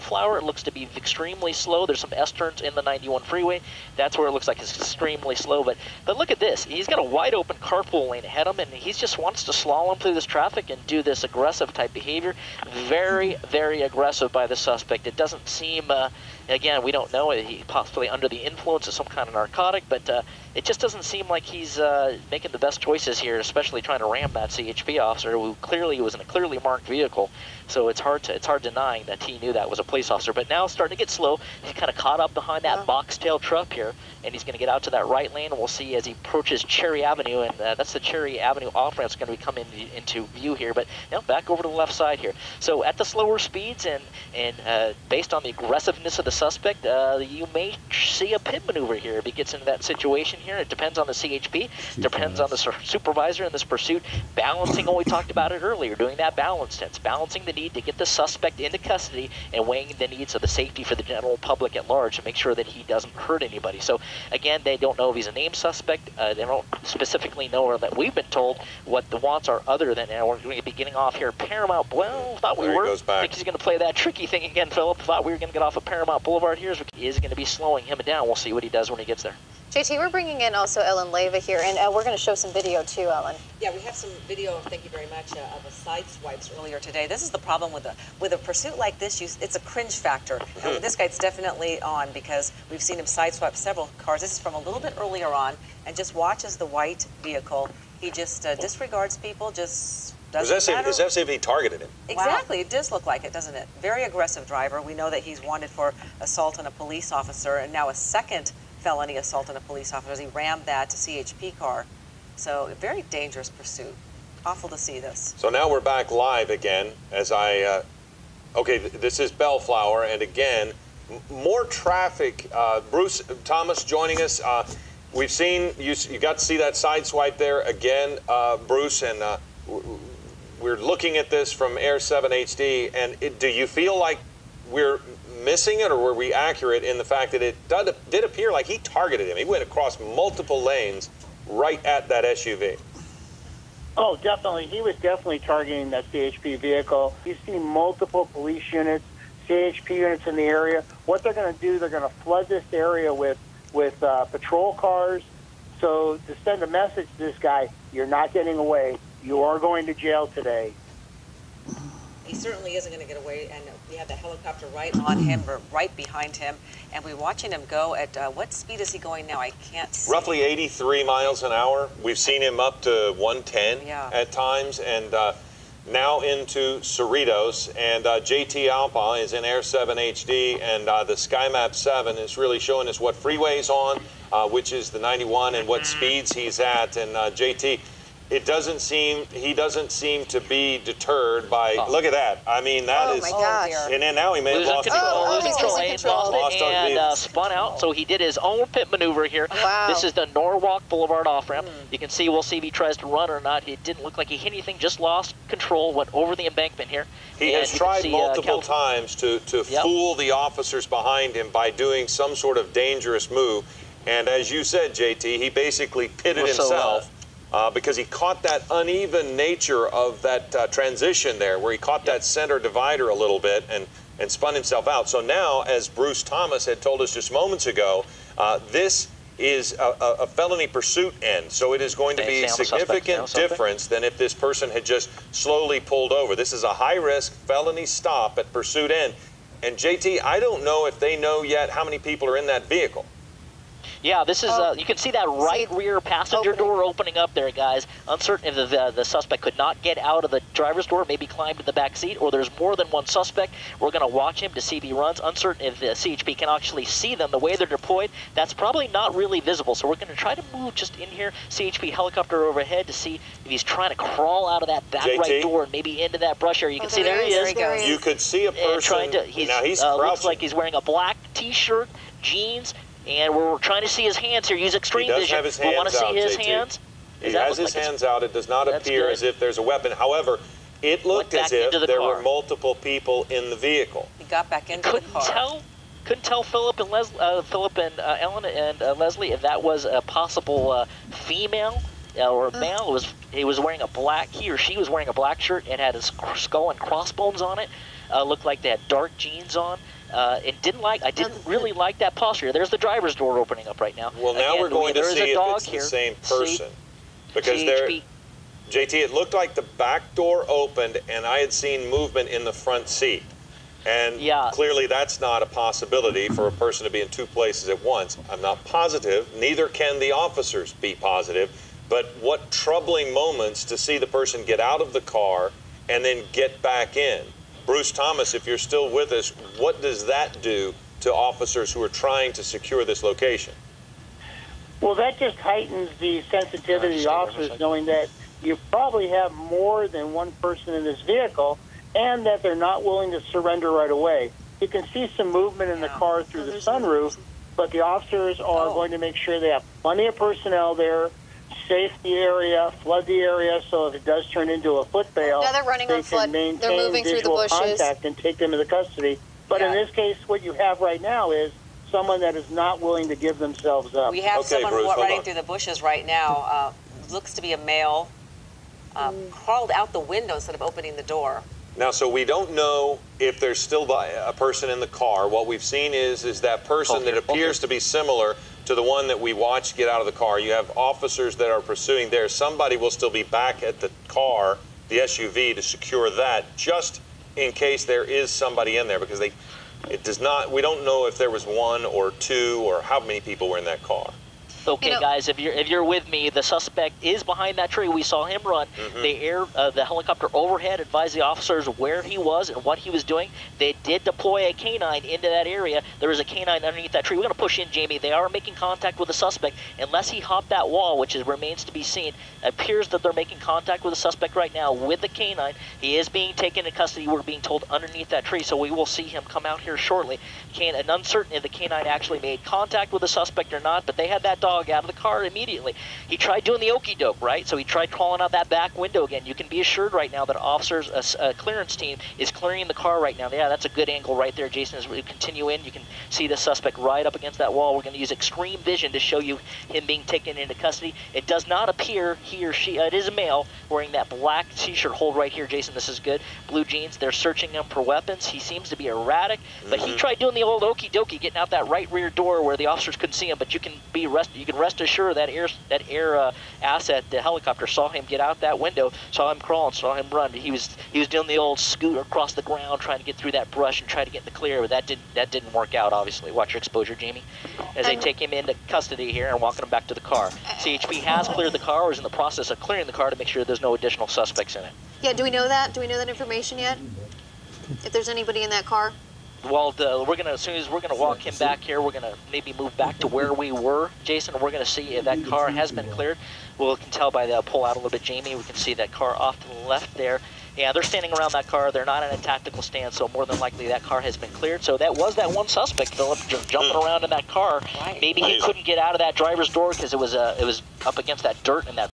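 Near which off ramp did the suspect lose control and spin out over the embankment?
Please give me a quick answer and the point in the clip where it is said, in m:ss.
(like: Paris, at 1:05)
Norwalk Boulevard, at 3:20.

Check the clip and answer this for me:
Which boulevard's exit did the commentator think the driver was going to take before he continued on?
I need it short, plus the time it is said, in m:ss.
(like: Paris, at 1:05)
Paramount Boulevard, at 1:15.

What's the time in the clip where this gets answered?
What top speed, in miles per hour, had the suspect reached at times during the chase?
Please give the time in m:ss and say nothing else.
2:53.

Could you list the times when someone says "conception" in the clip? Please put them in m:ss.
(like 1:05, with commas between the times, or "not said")
not said.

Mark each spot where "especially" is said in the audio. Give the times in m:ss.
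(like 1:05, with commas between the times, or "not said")
0:23.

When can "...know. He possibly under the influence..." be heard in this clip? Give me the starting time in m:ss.
0:17.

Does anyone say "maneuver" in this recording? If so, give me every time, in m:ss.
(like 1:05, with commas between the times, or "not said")
0:48, 3:18.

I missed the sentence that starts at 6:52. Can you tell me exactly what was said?
It appears that they're making contact with the suspect right now with the canine.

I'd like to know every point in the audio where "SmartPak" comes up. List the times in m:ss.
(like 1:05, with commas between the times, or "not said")
not said.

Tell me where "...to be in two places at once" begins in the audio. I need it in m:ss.
5:16.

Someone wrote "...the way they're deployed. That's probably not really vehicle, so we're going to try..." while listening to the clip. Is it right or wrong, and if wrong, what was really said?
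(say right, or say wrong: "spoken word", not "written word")
wrong: "visible", not "vehicle".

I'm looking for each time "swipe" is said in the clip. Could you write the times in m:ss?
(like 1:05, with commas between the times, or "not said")
1:26, 1:33, 2:07.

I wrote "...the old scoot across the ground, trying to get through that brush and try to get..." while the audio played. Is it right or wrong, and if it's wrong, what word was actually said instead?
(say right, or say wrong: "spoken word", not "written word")
right.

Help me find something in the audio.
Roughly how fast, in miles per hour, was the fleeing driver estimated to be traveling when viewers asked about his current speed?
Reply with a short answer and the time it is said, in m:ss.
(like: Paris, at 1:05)
83, at 2:50.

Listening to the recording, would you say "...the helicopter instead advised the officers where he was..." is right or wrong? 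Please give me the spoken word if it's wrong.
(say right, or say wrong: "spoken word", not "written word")
wrong: "overhead", not "instead".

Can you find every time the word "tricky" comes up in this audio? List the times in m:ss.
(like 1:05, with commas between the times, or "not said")
1:13.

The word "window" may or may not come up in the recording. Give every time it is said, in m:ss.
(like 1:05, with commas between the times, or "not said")
6:09, 7:08, 7:38.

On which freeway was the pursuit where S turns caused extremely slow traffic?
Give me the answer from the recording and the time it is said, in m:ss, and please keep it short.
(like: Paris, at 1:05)
91, at 0:02.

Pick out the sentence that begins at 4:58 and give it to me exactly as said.
Uh, looked like they had dark jeans on.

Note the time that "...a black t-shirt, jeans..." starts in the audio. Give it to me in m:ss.
4:30.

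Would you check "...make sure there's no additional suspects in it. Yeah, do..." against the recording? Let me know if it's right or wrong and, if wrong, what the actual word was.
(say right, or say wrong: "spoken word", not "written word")
right.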